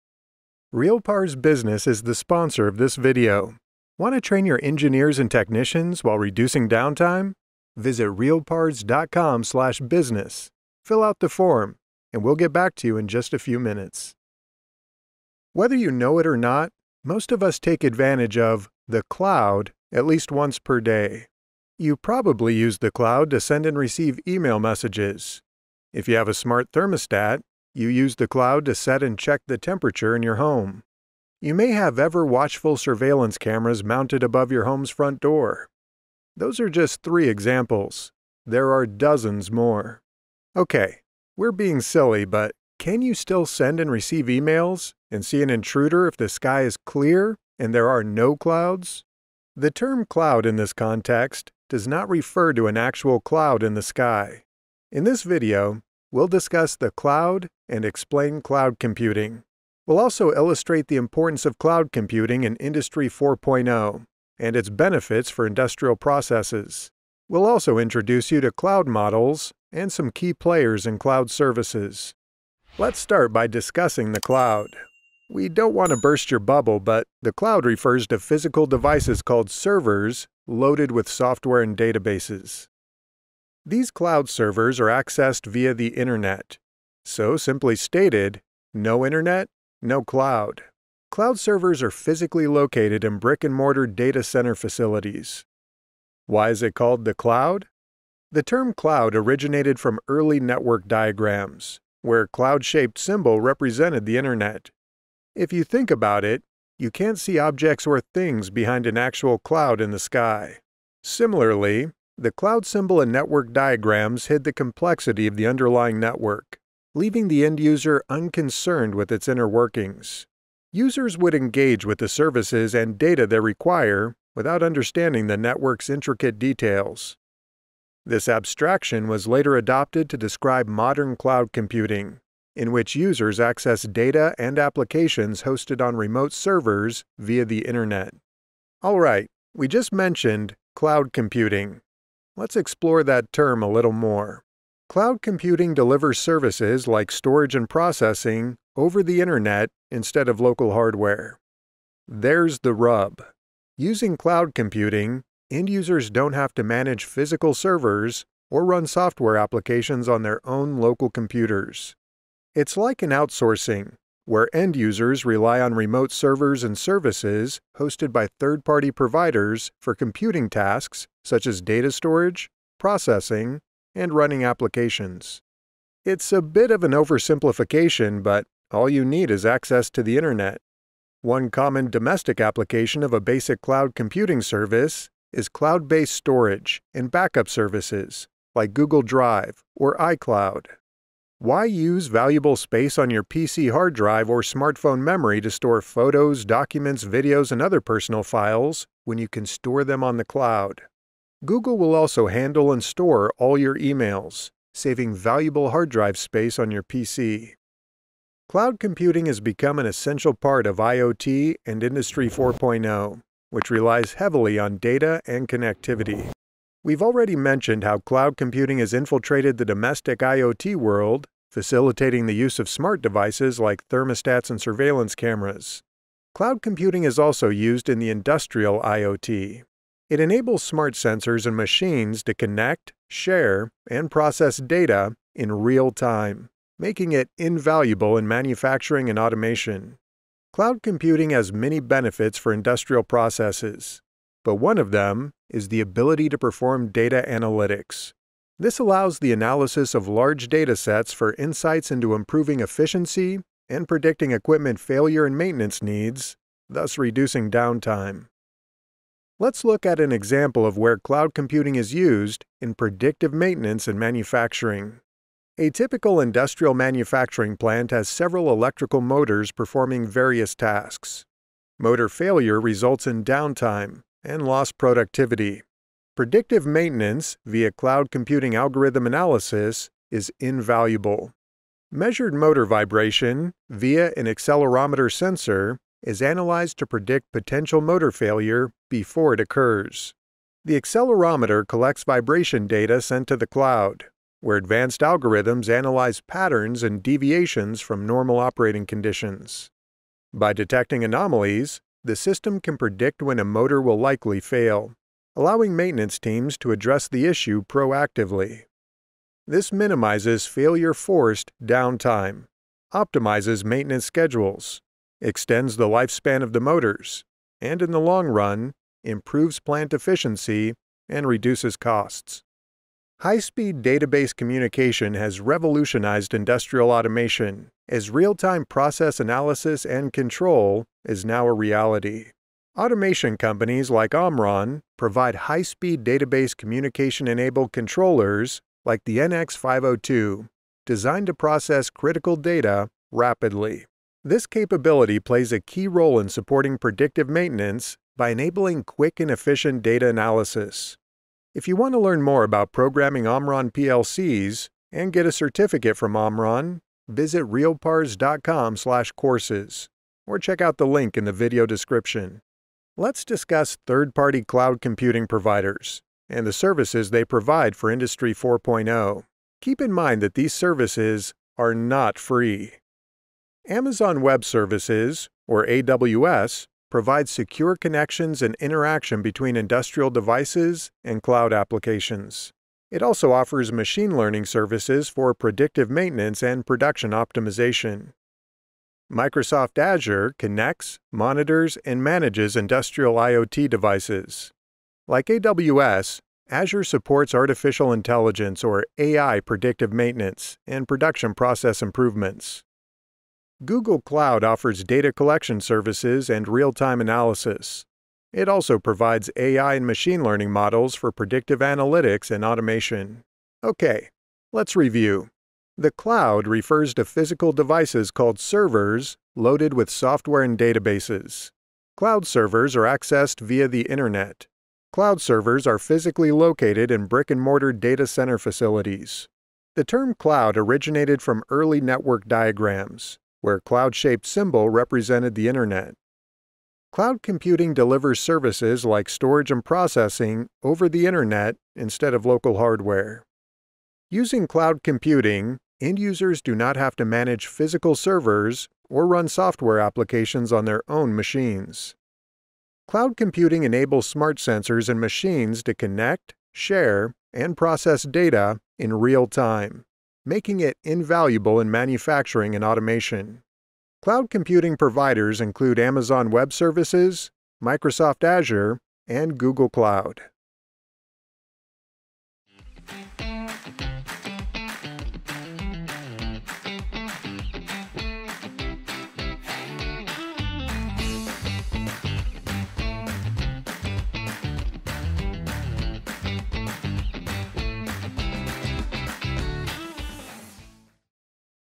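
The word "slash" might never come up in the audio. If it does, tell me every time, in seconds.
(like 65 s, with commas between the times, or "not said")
9 s.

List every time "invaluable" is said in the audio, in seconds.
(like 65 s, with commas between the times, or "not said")
237 s, 280 s, 460 s.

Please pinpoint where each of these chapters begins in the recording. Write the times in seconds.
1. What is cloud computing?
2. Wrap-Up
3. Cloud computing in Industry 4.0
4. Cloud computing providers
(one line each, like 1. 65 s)
1. 72 s
2. 413 s
3. 208 s
4. 363 s.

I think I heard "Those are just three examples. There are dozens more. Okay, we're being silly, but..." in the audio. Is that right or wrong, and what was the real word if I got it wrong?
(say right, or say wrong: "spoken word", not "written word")
right.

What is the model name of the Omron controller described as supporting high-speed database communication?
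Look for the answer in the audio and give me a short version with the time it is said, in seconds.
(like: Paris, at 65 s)
NX502, at 339 s.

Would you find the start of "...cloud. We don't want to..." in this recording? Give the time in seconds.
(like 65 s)
74 s.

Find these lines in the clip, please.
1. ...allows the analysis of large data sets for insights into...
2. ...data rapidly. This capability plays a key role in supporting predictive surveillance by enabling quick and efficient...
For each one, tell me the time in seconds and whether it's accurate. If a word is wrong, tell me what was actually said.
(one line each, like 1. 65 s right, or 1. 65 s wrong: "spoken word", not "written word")
1. 248 s right
2. 342 s wrong: "maintenance", not "surveillance".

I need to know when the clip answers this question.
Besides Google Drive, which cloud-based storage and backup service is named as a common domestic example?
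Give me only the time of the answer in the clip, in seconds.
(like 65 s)
189 s.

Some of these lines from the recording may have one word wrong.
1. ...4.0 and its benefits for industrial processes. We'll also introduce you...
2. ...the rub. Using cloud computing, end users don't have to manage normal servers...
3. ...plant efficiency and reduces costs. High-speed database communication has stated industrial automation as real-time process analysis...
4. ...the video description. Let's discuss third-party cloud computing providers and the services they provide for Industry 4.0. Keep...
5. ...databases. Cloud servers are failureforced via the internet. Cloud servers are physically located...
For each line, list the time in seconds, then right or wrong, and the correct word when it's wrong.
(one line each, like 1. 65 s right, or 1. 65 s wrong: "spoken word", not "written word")
1. 63 s right
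2. 152 s wrong: "physical", not "normal"
3. 319 s wrong: "revolutionized", not "stated"
4. 361 s right
5. 420 s wrong: "accessed", not "failureforced".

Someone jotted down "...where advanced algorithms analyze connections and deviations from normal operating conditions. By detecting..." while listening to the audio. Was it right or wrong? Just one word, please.
wrong.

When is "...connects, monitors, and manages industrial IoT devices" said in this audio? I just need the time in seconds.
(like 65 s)
390 s.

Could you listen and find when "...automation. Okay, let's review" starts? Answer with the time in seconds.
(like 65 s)
412 s.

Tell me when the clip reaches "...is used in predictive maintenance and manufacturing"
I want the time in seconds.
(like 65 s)
261 s.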